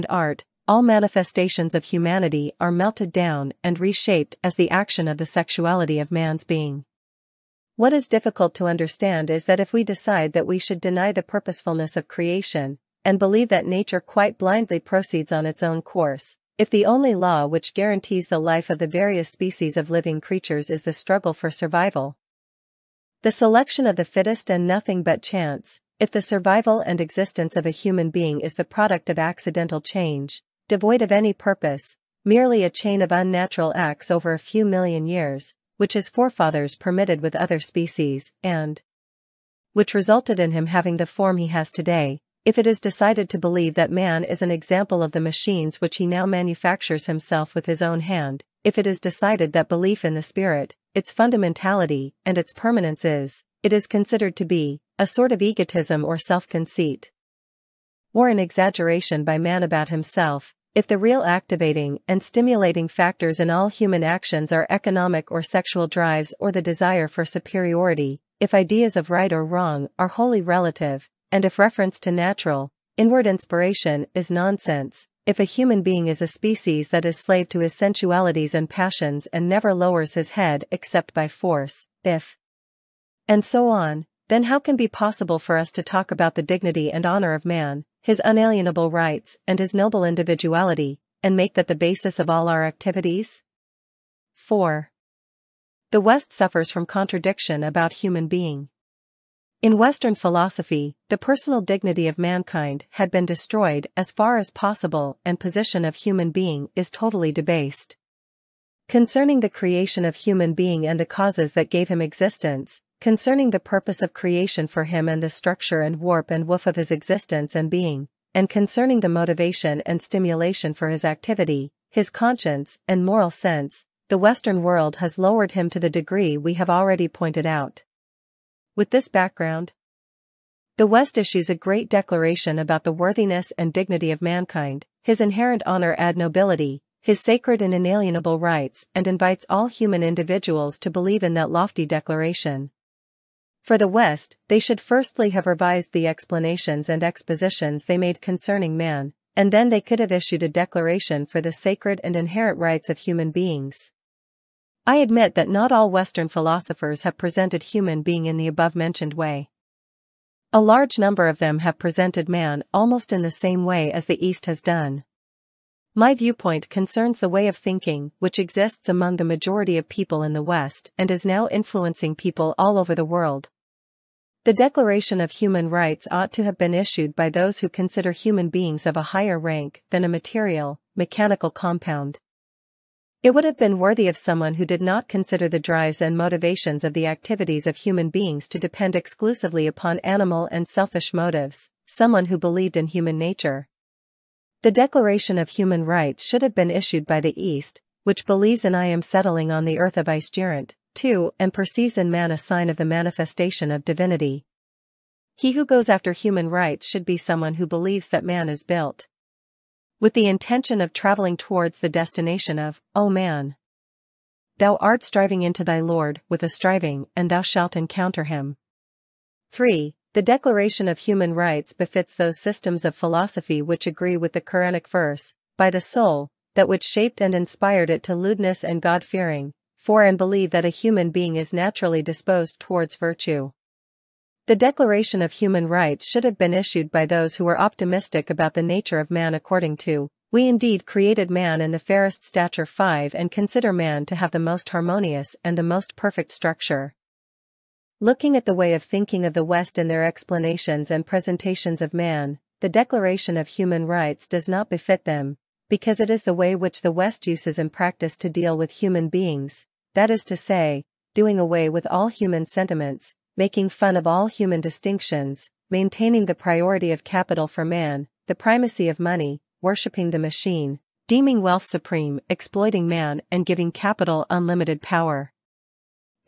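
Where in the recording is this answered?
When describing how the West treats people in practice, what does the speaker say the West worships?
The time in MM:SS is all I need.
04:29.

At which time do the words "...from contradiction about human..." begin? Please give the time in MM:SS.
01:36.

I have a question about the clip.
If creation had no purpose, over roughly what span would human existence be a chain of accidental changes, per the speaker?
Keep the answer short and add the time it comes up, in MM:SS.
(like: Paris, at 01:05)
a few million years, at 00:34.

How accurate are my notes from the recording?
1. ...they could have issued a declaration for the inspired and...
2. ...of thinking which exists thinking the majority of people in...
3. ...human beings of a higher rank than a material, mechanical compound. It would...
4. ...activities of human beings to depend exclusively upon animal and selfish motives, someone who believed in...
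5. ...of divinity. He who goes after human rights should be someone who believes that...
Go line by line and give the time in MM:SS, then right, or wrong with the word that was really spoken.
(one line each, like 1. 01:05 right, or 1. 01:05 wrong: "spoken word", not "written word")
1. 02:29 wrong: "sacred", not "inspired"
2. 02:47 wrong: "among", not "thinking"
3. 02:58 right
4. 03:07 right
5. 03:23 right.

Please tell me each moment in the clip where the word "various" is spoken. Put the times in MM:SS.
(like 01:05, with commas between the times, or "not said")
00:18.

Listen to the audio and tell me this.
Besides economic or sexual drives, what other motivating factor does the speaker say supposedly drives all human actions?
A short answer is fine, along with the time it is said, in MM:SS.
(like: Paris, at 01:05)
desire for superiority, at 01:06.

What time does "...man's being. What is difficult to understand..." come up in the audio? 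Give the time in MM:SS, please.
00:06.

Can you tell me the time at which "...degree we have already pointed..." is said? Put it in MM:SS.
02:05.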